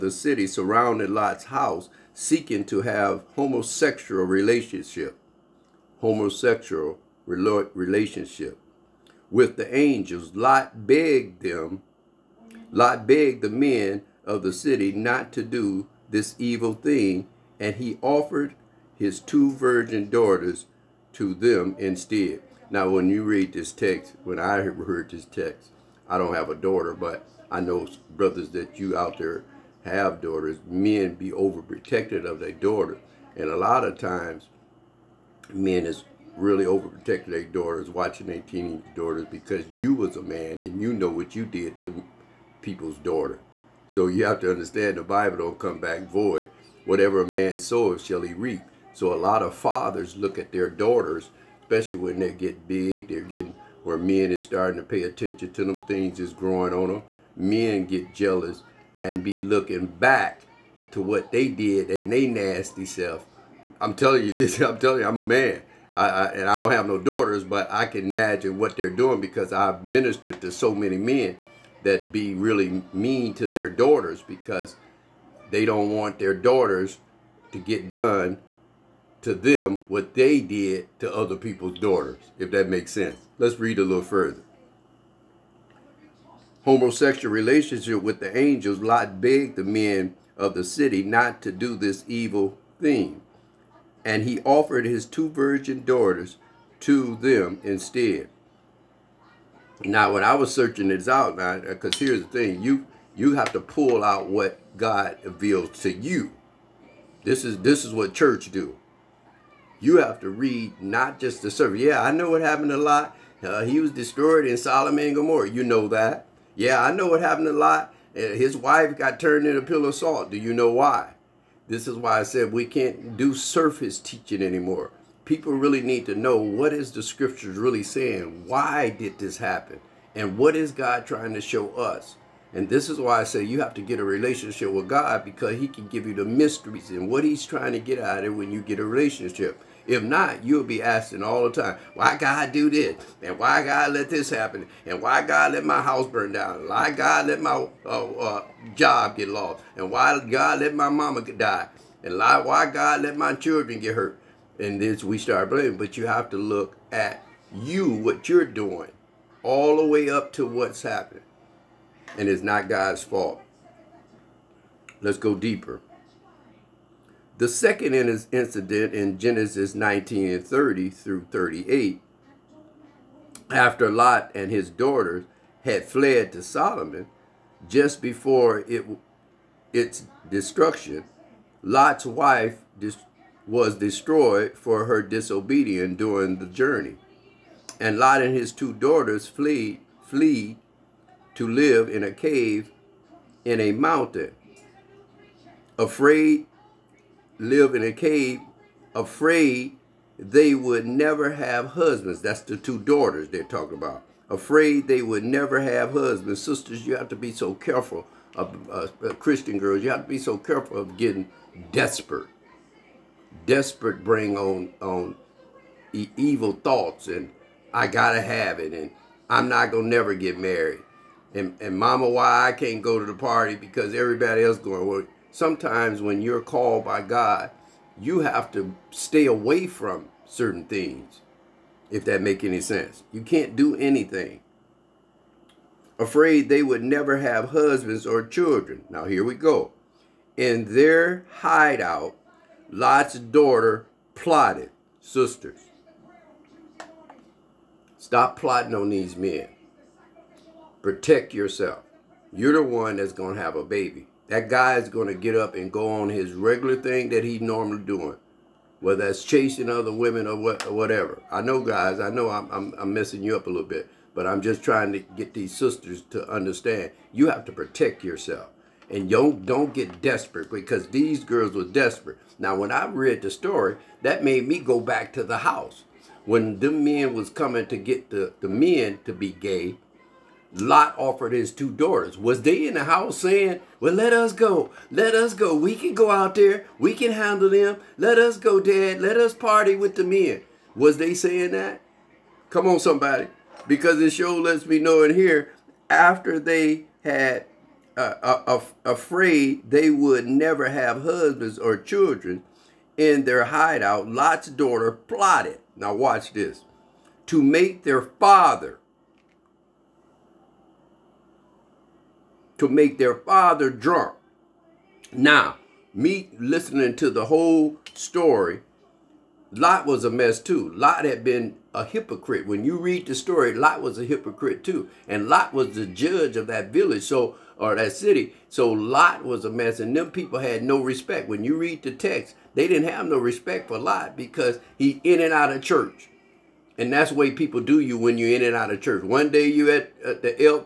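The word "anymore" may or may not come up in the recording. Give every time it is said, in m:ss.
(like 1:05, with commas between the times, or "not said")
2:04.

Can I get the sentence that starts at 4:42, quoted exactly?
Was they in the house saying, well, let us go.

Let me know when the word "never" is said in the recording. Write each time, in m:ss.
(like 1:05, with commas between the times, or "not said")
3:20, 3:25, 3:39, 3:56, 5:00.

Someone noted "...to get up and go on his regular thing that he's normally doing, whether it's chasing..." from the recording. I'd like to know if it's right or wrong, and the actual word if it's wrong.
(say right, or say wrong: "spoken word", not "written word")
right.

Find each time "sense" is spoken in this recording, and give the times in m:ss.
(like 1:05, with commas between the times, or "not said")
1:22, 3:52.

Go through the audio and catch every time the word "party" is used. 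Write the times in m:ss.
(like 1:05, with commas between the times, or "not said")
3:43, 4:49.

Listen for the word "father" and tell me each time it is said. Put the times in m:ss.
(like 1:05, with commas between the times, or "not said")
0:49, 5:08, 5:13.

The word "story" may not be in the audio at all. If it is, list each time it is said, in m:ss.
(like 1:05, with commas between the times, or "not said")
4:33, 5:17, 5:23.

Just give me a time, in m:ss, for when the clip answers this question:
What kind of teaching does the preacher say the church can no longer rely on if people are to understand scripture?
2:03.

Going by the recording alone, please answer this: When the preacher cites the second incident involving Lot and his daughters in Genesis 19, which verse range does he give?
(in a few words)
30 through 38.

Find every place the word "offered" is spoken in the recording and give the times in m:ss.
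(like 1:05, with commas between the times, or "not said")
0:18, 1:34, 4:40.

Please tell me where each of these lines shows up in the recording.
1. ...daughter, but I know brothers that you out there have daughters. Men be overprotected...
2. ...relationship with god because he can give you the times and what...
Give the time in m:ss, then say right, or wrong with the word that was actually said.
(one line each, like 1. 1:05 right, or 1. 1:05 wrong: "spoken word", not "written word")
1. 0:26 right
2. 2:14 wrong: "mysteries", not "times".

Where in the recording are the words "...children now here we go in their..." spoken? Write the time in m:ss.
3:58.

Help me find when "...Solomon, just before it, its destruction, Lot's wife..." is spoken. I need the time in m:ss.
2:56.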